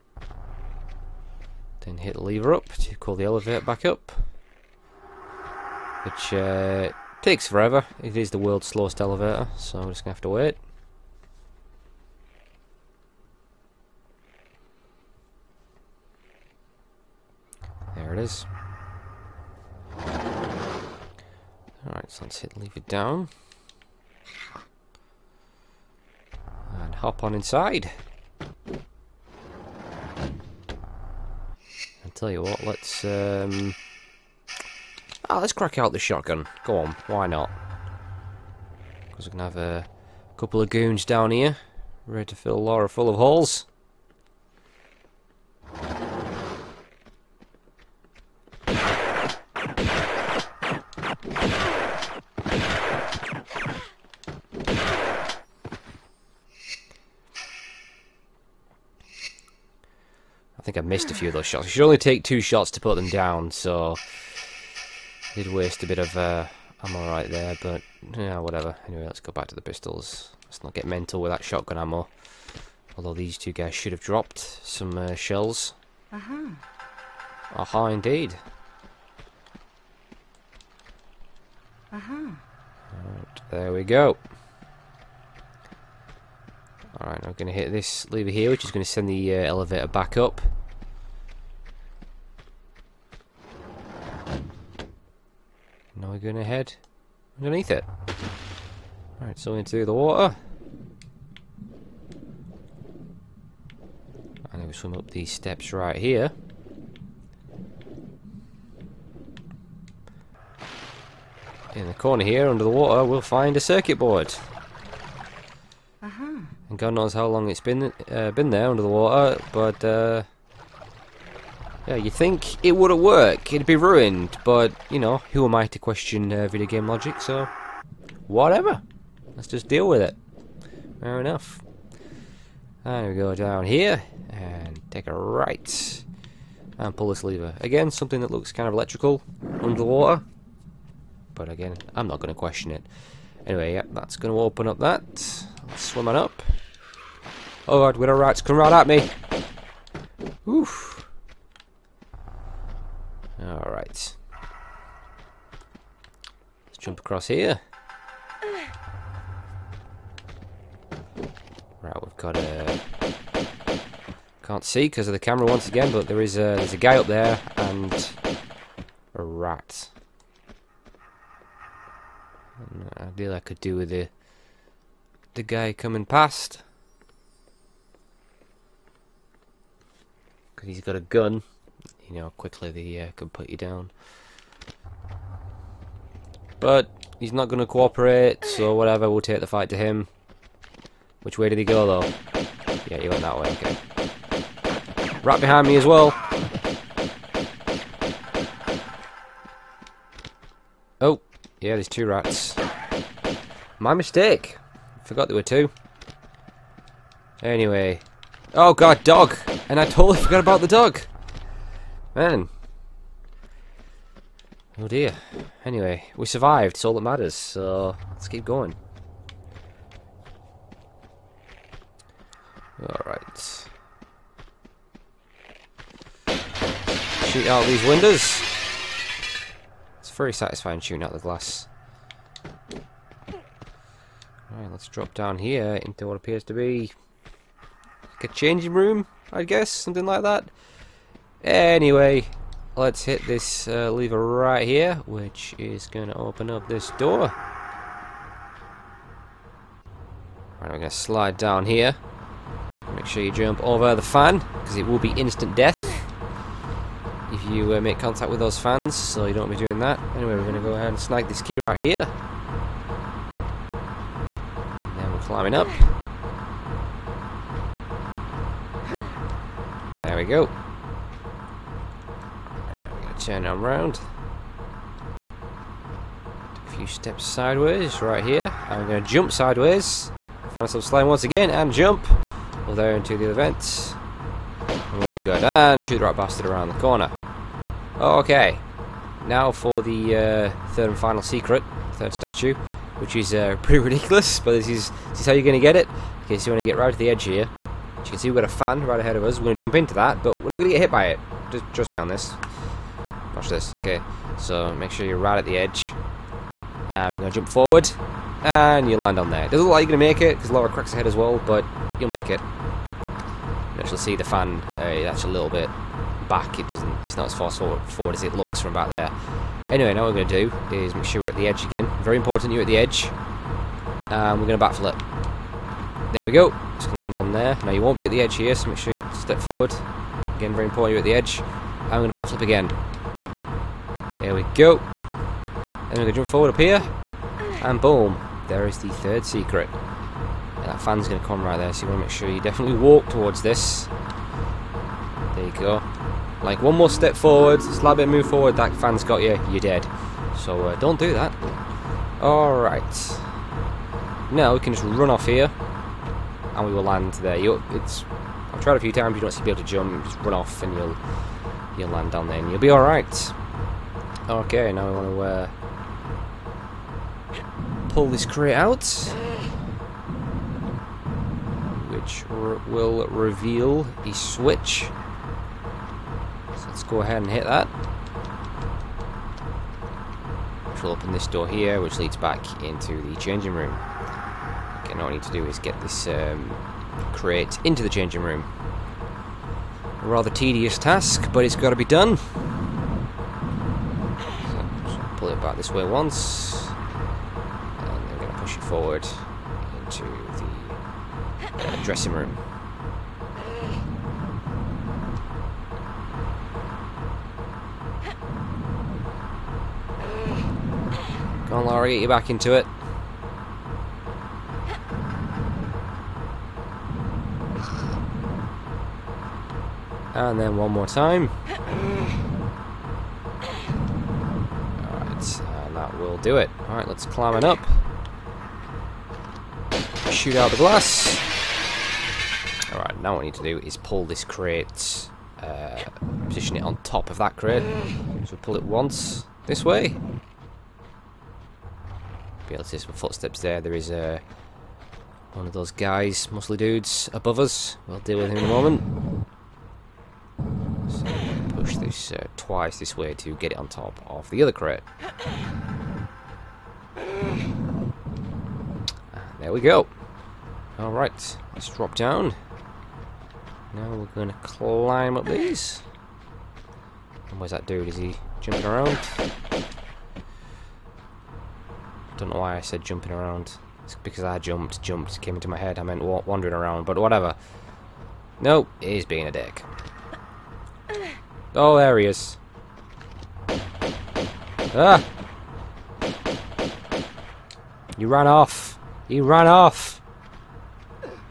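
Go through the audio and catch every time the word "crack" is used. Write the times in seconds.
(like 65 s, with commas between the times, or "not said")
35 s, 310 s.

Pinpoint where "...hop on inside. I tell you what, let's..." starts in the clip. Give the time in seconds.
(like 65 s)
26 s.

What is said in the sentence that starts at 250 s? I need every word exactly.
Right, I'm going to slide down here.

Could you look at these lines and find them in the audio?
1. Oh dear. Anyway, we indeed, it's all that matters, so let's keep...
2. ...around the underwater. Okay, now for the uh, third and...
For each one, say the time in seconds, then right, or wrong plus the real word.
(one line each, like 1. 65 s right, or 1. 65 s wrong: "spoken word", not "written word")
1. 214 s wrong: "survived", not "indeed"
2. 286 s wrong: "corner", not "underwater".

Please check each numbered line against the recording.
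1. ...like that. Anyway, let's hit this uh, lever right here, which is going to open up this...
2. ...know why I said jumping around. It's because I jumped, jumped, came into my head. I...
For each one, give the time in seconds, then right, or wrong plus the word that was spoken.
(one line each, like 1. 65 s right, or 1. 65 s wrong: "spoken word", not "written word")
1. 240 s right
2. 472 s right.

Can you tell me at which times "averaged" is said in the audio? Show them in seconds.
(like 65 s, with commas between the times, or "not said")
not said.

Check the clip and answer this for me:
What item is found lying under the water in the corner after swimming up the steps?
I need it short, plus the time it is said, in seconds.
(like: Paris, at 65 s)
Circuit board, at 113 s.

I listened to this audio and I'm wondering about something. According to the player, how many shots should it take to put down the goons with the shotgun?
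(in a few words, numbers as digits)
2.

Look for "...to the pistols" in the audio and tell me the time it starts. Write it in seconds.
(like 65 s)
69 s.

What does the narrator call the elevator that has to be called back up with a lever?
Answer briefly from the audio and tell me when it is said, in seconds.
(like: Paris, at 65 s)
World's slowest elevator, at 8 s.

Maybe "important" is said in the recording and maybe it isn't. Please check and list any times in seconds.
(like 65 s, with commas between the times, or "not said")
322 s, 330 s.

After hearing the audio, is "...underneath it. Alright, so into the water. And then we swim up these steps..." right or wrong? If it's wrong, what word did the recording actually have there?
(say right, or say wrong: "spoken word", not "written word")
right.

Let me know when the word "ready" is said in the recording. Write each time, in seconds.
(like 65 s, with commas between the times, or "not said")
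42 s.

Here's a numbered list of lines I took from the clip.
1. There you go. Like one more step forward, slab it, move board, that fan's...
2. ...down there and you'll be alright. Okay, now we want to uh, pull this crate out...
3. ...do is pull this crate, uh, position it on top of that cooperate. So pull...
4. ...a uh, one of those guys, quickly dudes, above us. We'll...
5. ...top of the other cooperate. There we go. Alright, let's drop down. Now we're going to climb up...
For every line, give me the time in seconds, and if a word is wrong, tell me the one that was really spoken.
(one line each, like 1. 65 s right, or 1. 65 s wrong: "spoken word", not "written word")
1. 345 s wrong: "forward", not "board"
2. 362 s right
3. 433 s wrong: "crate", not "cooperate"
4. 443 s wrong: "muscly", not "quickly"
5. 453 s wrong: "crate", not "cooperate".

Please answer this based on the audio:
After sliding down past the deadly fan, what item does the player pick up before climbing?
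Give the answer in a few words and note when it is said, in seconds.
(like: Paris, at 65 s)
Key, at 261 s.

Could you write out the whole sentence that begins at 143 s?
Anyway, yeah, that's going to open up that.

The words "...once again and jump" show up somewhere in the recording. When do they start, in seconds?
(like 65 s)
281 s.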